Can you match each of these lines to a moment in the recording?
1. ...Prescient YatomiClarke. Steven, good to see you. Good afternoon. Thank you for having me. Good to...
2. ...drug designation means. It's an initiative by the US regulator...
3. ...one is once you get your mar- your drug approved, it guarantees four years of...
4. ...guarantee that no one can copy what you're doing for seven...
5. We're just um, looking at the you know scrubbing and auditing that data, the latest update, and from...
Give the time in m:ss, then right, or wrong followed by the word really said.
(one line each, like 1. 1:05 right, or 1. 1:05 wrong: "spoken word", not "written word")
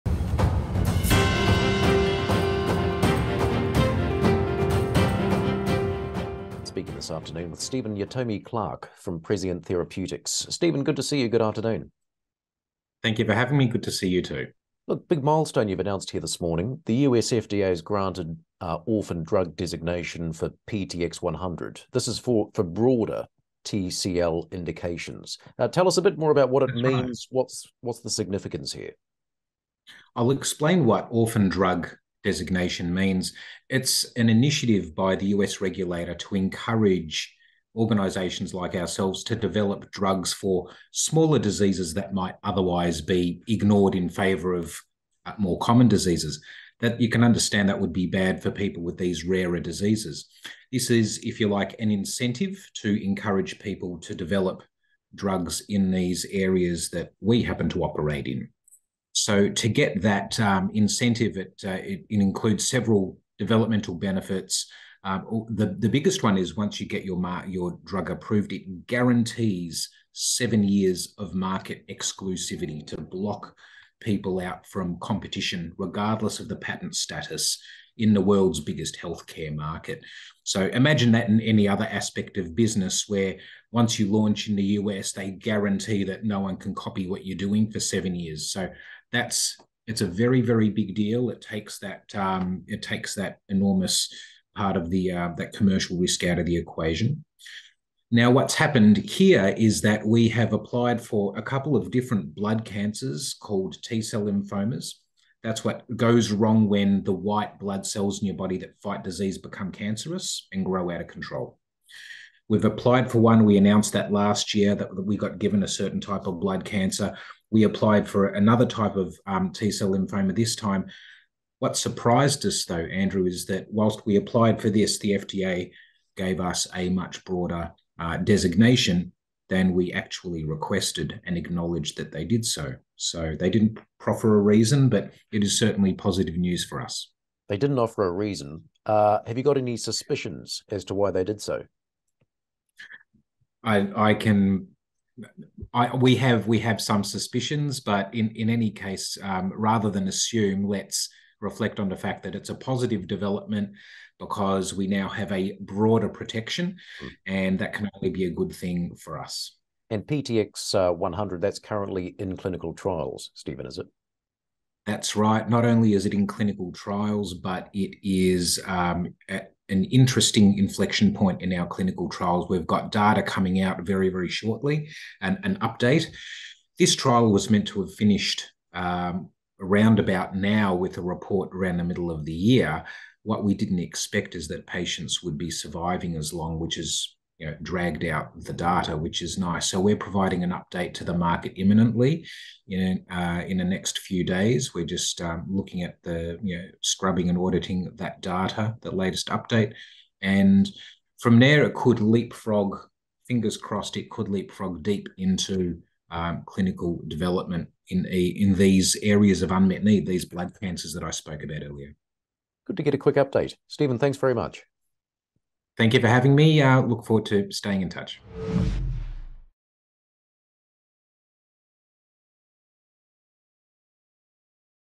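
1. 0:09 wrong: "Therapeutics", not "YatomiClarke"
2. 0:31 right
3. 1:06 wrong: "seven", not "four"
4. 1:25 right
5. 3:14 right.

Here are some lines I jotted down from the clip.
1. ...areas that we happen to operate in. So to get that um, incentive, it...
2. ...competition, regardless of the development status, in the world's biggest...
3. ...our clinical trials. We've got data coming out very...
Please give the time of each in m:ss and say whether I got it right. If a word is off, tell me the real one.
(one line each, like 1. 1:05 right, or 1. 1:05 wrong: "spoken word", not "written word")
1. 0:56 right
2. 1:14 wrong: "patent", not "development"
3. 2:51 right.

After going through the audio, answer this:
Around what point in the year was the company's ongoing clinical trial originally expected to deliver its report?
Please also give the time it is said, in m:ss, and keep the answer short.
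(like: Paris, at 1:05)
the middle of the year, at 3:01.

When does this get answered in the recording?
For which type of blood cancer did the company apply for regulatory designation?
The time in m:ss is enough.
1:43.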